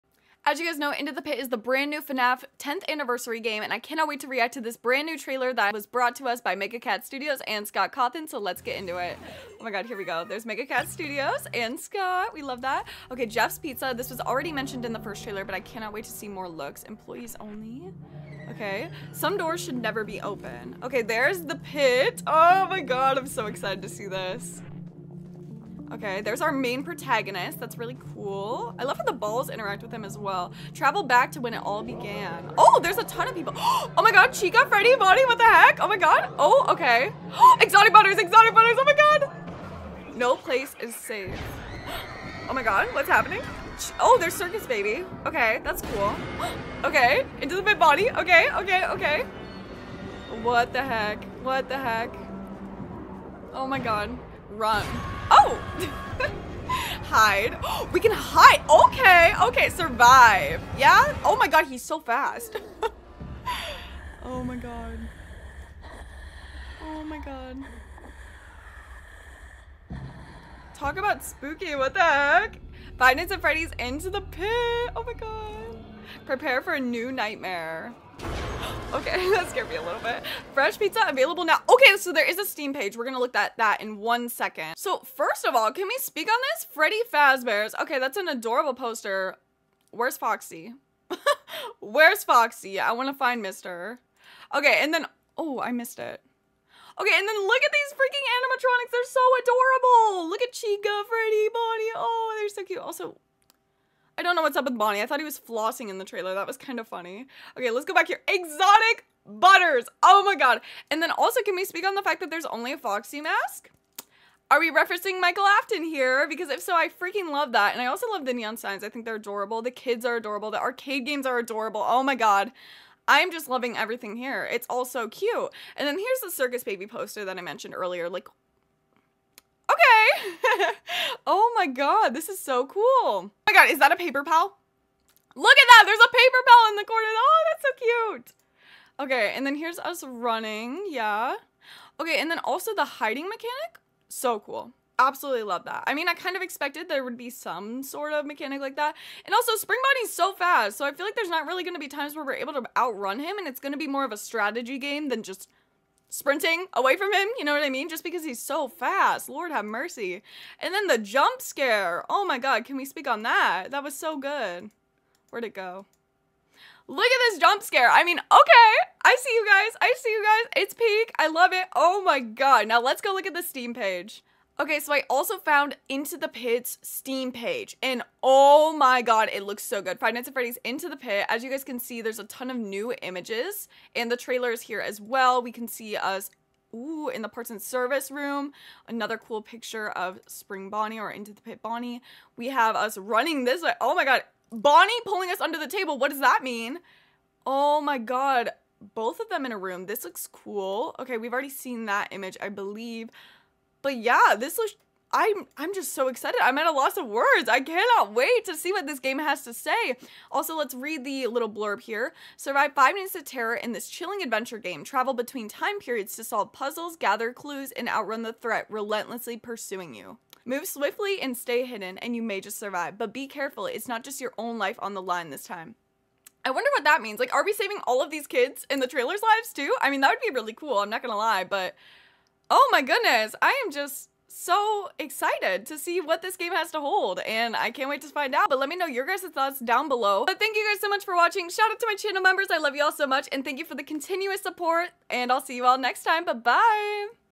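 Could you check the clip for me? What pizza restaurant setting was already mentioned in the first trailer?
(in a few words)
Jeff's Pizza.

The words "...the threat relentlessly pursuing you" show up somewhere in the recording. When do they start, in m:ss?
3:38.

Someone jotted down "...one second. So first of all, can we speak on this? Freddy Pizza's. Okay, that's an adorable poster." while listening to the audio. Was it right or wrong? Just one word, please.
wrong.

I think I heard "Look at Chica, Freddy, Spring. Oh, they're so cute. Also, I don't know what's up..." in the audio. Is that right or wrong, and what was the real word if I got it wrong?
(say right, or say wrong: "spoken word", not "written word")
wrong: "Bonnie", not "Spring".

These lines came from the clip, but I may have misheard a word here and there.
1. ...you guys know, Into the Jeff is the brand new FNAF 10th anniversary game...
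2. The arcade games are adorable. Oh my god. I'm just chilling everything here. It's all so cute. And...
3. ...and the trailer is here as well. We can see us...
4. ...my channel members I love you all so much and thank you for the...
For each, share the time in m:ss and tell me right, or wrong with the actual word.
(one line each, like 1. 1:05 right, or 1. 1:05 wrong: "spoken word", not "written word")
1. 0:00 wrong: "Pit", not "Jeff"
2. 2:00 wrong: "loving", not "chilling"
3. 3:03 right
4. 4:01 right.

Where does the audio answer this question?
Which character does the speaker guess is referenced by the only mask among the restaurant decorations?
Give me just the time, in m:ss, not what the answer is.
1:55.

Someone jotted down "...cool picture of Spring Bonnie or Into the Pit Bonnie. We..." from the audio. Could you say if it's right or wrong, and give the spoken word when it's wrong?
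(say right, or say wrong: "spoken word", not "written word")
right.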